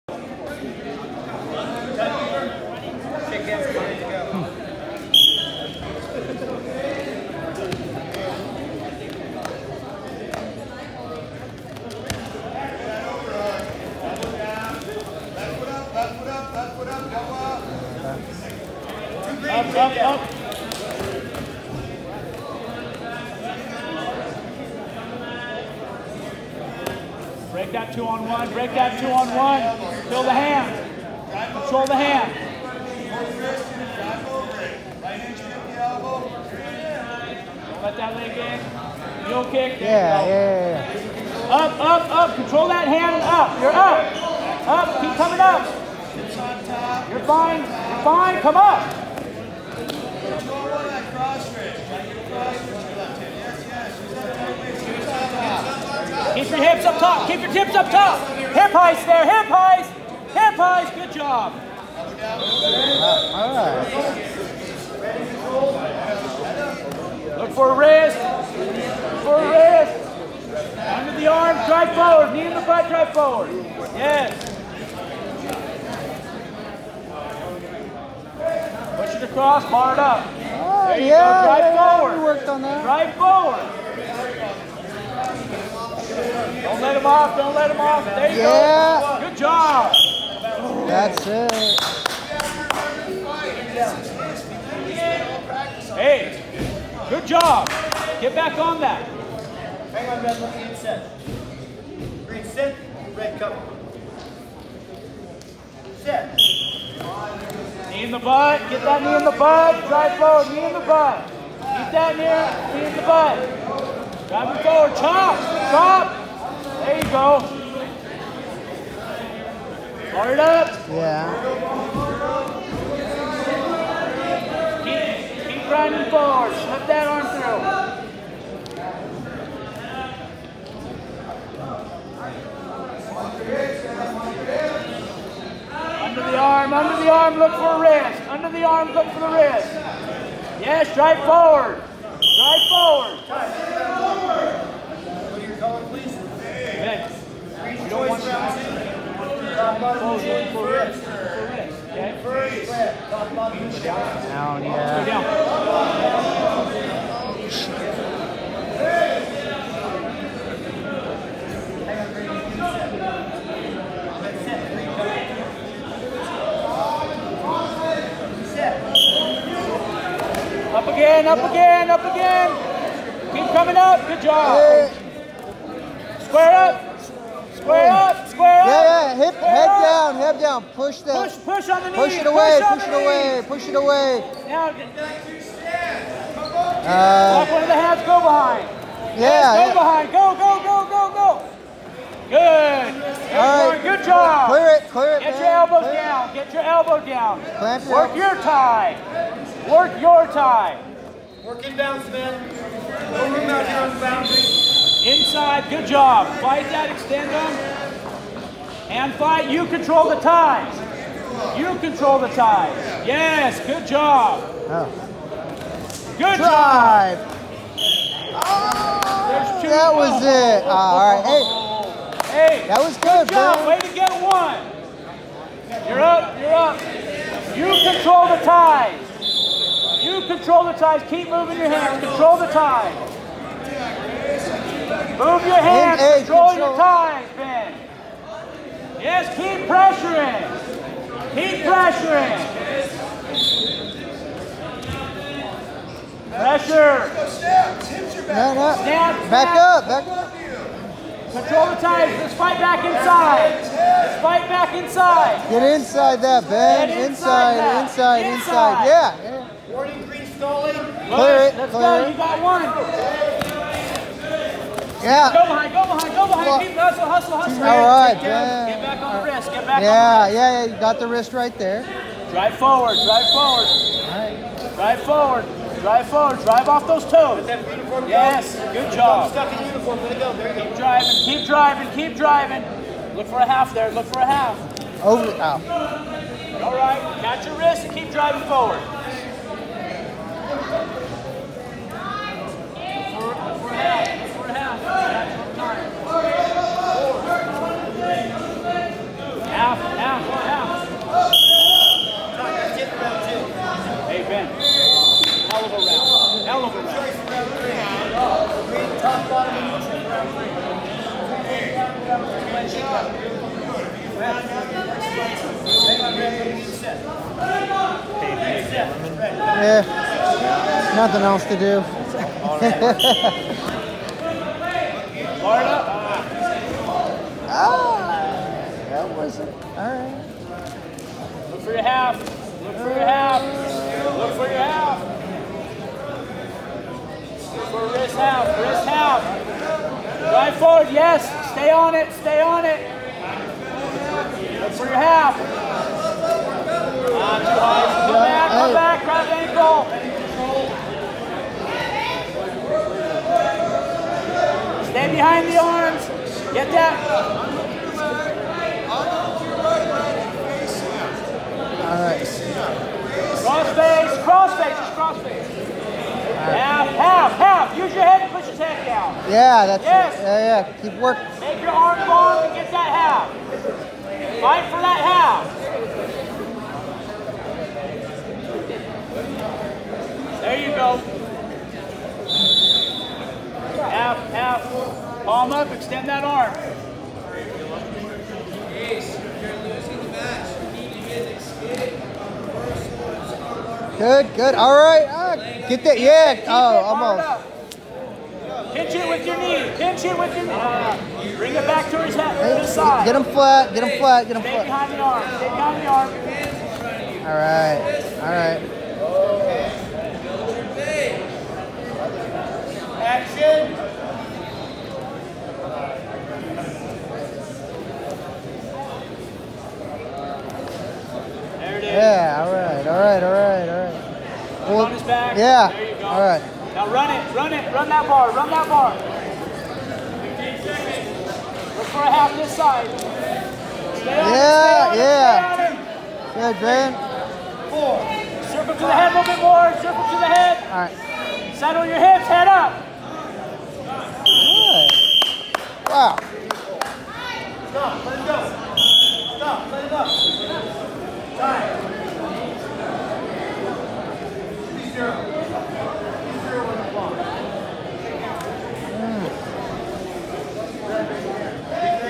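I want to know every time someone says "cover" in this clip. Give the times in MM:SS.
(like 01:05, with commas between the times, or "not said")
01:43.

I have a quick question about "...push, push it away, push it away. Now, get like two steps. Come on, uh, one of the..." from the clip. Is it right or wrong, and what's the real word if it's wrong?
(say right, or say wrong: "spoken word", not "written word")
right.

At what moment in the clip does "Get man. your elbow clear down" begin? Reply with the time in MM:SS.
03:15.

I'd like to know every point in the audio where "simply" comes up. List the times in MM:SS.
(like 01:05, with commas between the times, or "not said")
not said.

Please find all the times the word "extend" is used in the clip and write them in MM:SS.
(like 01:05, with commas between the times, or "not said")
03:26, 06:25.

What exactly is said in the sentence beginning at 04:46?
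All right, catch your wrist and keep driving forward.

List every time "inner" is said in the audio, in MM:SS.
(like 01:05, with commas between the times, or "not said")
not said.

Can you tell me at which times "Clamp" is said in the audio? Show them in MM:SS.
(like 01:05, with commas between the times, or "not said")
03:17.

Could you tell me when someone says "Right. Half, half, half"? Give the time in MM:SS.
06:05.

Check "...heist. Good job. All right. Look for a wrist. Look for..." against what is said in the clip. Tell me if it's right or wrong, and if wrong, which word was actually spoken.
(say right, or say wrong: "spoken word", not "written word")
right.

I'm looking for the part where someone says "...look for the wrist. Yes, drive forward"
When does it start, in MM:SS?
02:18.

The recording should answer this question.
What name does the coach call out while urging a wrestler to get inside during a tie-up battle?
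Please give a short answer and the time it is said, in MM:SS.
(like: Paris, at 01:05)
Ben, at 04:15.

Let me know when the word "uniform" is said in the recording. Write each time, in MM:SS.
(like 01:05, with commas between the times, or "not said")
04:39.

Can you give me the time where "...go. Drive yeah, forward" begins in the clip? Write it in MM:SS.
01:21.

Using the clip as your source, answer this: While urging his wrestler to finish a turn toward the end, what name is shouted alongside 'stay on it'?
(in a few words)
Graham.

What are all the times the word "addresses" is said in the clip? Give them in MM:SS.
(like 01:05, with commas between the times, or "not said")
not said.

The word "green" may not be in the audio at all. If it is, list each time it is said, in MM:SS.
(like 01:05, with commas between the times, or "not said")
01:42, 04:20.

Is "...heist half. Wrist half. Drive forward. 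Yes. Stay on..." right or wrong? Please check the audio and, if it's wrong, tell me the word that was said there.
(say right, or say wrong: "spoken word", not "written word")
wrong: "wrist", not "heist".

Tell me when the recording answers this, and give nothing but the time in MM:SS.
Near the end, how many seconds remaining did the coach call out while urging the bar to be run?
07:08.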